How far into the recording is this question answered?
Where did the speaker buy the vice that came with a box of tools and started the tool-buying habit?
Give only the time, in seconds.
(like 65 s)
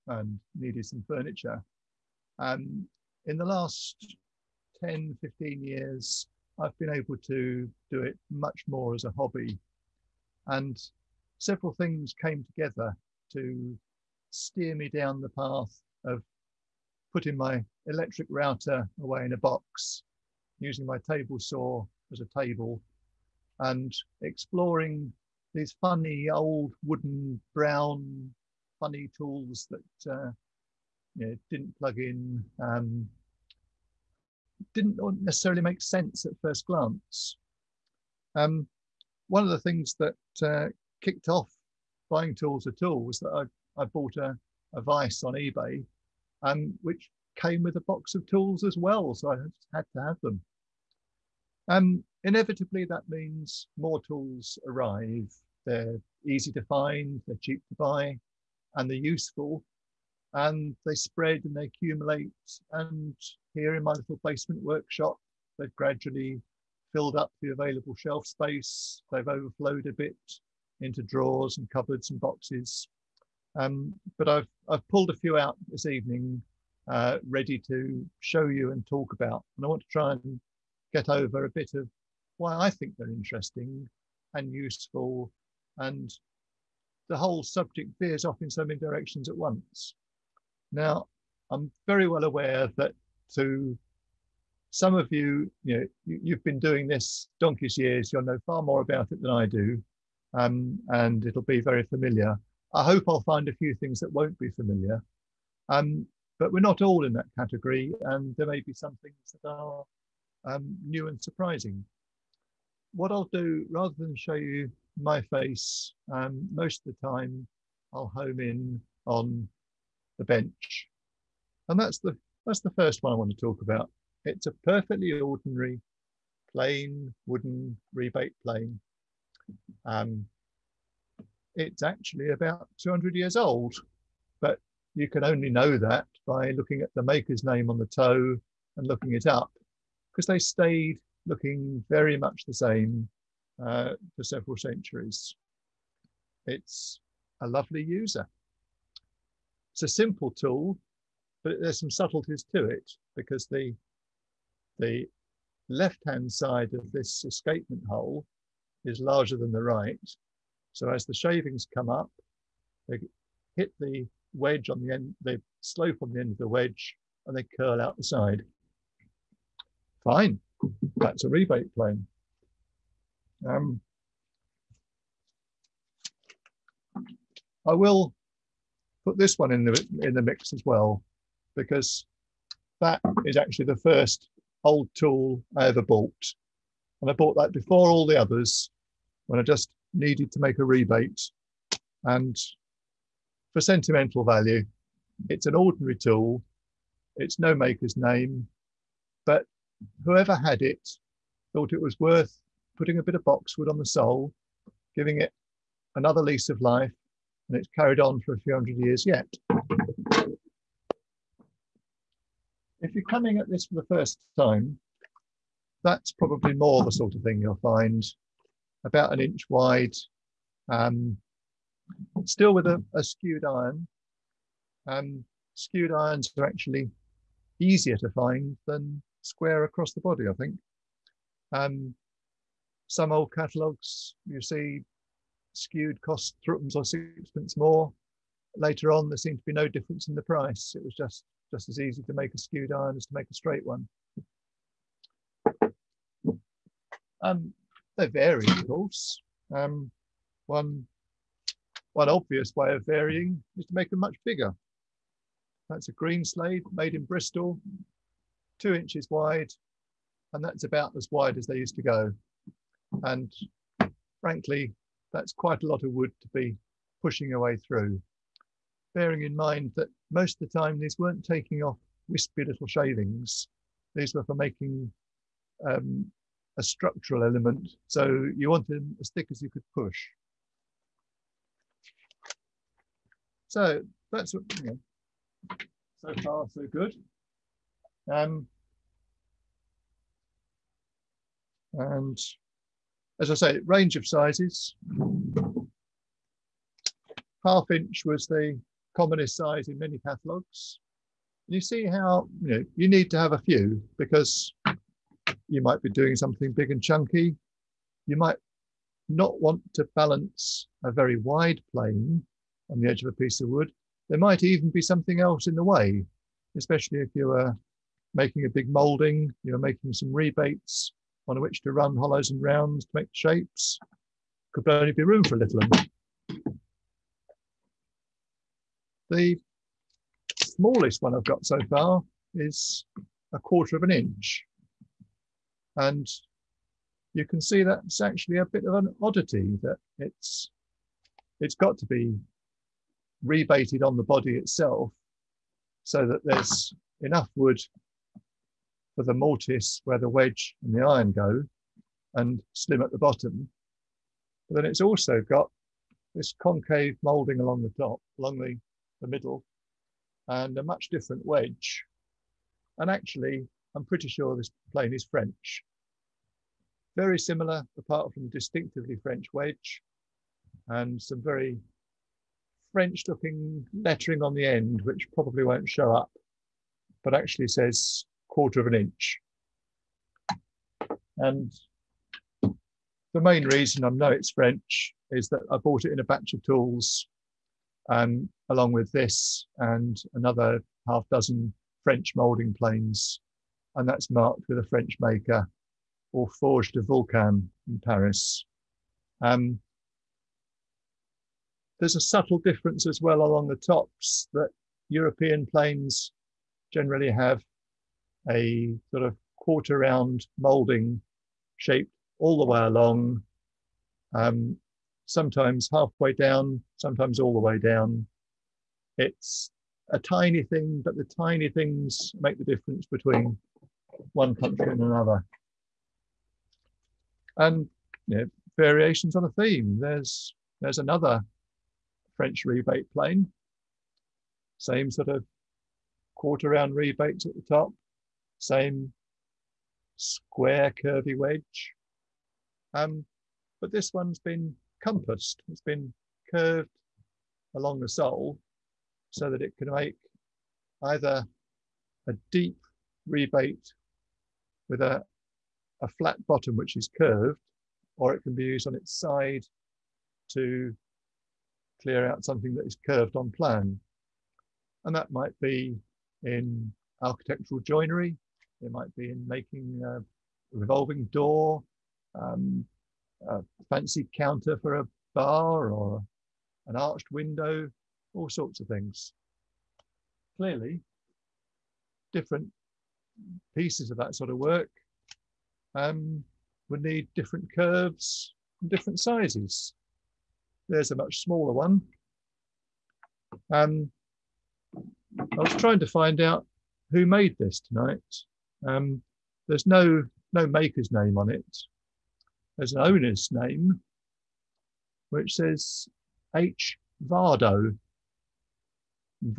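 45 s.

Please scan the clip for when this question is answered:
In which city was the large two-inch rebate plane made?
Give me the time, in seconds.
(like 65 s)
257 s.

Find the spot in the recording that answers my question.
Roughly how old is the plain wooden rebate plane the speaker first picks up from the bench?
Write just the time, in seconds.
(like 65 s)
132 s.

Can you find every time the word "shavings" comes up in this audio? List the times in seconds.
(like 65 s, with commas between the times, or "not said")
161 s, 272 s.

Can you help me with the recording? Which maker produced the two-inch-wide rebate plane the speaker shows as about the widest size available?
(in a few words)
Greenslade.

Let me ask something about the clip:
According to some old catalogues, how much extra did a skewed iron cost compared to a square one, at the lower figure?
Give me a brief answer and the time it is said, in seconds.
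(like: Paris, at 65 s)
threepence, at 236 s.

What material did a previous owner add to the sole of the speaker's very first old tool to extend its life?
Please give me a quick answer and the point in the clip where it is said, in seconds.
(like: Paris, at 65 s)
boxwood, at 203 s.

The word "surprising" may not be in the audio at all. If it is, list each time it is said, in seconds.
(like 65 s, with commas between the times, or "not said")
111 s.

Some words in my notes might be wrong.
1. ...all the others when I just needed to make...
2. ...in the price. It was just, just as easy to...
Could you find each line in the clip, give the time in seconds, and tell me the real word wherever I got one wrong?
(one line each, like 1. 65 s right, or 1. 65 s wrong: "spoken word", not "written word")
1. 187 s right
2. 240 s right.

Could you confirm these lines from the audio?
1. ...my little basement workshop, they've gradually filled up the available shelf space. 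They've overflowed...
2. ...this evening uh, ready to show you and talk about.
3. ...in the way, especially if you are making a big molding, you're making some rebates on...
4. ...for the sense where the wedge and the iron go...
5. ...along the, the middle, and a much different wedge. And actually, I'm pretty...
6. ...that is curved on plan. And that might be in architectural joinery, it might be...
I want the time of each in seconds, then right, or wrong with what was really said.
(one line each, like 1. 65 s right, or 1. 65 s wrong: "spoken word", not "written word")
1. 63 s right
2. 75 s right
3. 315 s right
4. 348 s wrong: "mortise", not "sense"
5. 358 s right
6. 462 s right.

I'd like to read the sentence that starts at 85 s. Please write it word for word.
And the whole subject veers off in so many directions at once.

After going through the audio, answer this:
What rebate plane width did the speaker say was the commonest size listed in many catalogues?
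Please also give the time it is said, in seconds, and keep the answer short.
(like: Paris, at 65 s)
Half inch, at 297 s.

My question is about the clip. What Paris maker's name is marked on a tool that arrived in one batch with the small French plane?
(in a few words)
Forges de Vulcain.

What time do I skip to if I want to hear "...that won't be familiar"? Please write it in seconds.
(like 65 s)
103 s.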